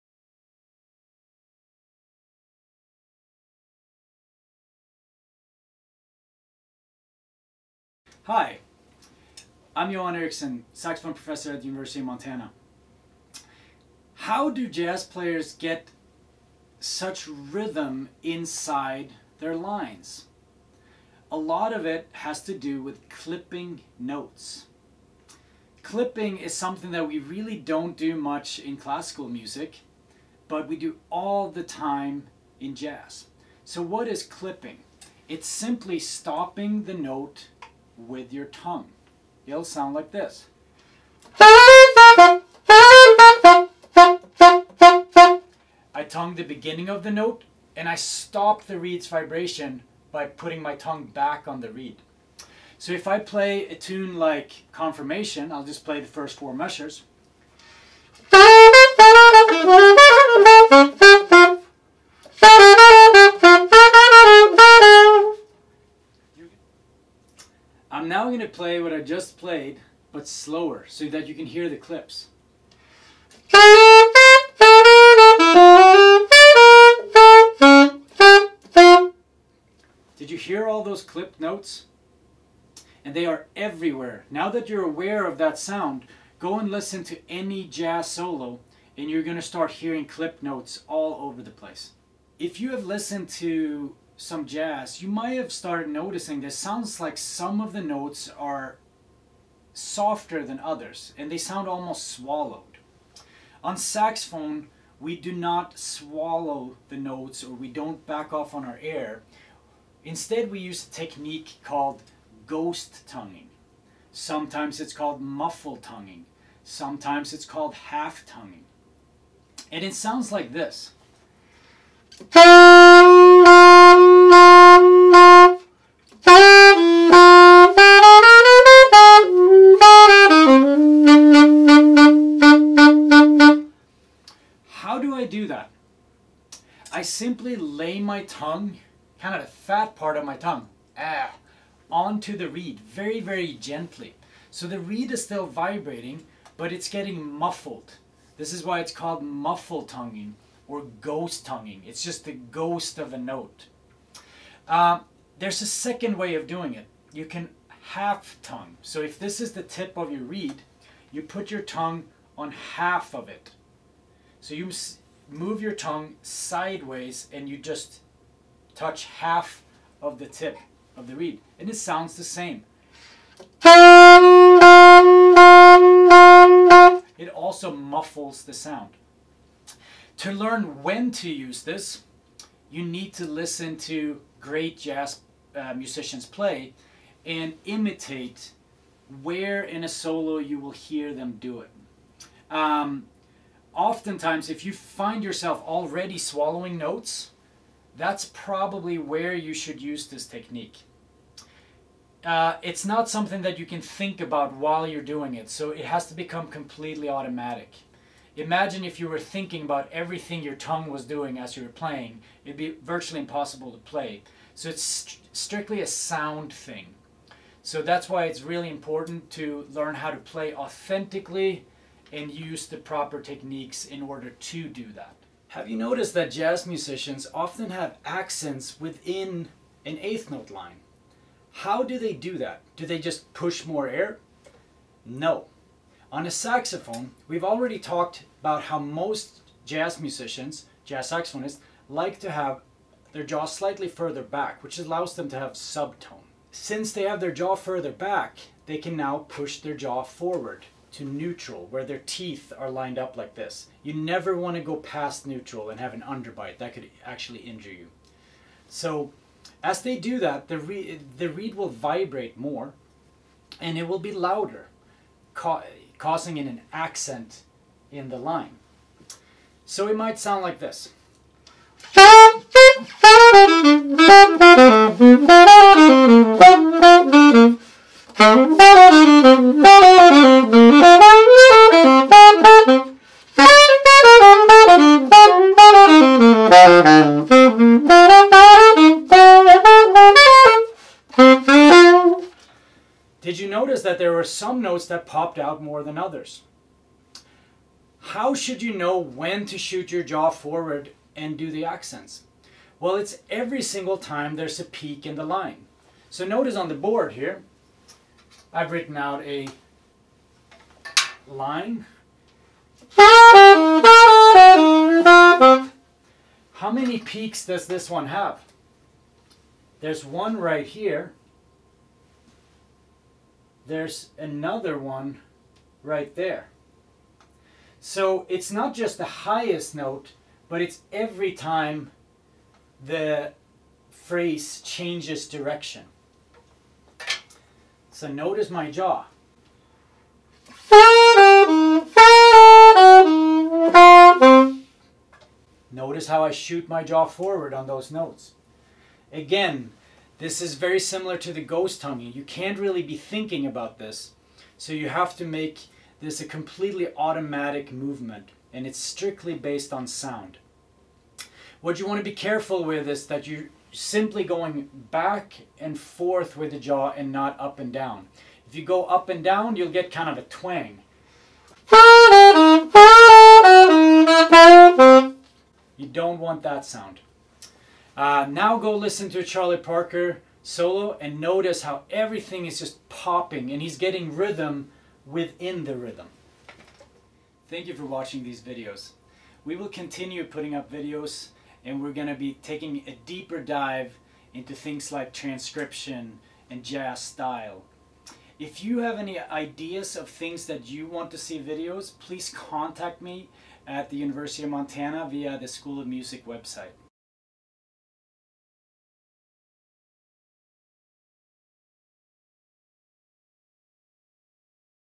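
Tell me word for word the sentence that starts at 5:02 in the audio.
Well, it's every single time there's a peak in the line.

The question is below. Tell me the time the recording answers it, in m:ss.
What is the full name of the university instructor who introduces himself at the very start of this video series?
0:09.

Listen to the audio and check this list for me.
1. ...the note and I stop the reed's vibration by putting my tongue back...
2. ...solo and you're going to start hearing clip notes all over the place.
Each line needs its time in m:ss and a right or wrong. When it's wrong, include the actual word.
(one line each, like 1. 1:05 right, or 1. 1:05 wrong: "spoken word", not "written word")
1. 0:47 right
2. 1:28 right.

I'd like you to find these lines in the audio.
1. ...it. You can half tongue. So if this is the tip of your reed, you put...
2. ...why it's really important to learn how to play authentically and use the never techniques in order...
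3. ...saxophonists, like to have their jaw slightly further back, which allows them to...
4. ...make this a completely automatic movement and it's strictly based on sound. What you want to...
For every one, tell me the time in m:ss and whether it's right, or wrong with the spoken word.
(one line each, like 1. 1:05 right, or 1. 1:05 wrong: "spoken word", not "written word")
1. 2:36 right
2. 3:38 wrong: "proper", not "never"
3. 4:01 right
4. 5:55 right.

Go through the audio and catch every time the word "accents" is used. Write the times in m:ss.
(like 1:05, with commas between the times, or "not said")
3:48, 4:26, 5:01.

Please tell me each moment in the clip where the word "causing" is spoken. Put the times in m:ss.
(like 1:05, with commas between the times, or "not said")
4:26.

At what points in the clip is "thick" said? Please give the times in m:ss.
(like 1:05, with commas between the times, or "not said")
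not said.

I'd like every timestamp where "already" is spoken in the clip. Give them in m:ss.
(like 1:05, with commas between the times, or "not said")
3:15, 3:57.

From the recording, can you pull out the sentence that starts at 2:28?
This is why it's called muffle tonguing or ghost tonguing.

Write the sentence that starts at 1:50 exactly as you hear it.
Instead, we use a technique called ghost tonguing.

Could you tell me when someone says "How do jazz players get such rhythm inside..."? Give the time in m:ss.
0:14.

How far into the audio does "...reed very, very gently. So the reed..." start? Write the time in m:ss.
2:22.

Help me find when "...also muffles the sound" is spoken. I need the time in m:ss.
2:57.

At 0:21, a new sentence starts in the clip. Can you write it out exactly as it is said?
A lot of it has to do with clipping notes.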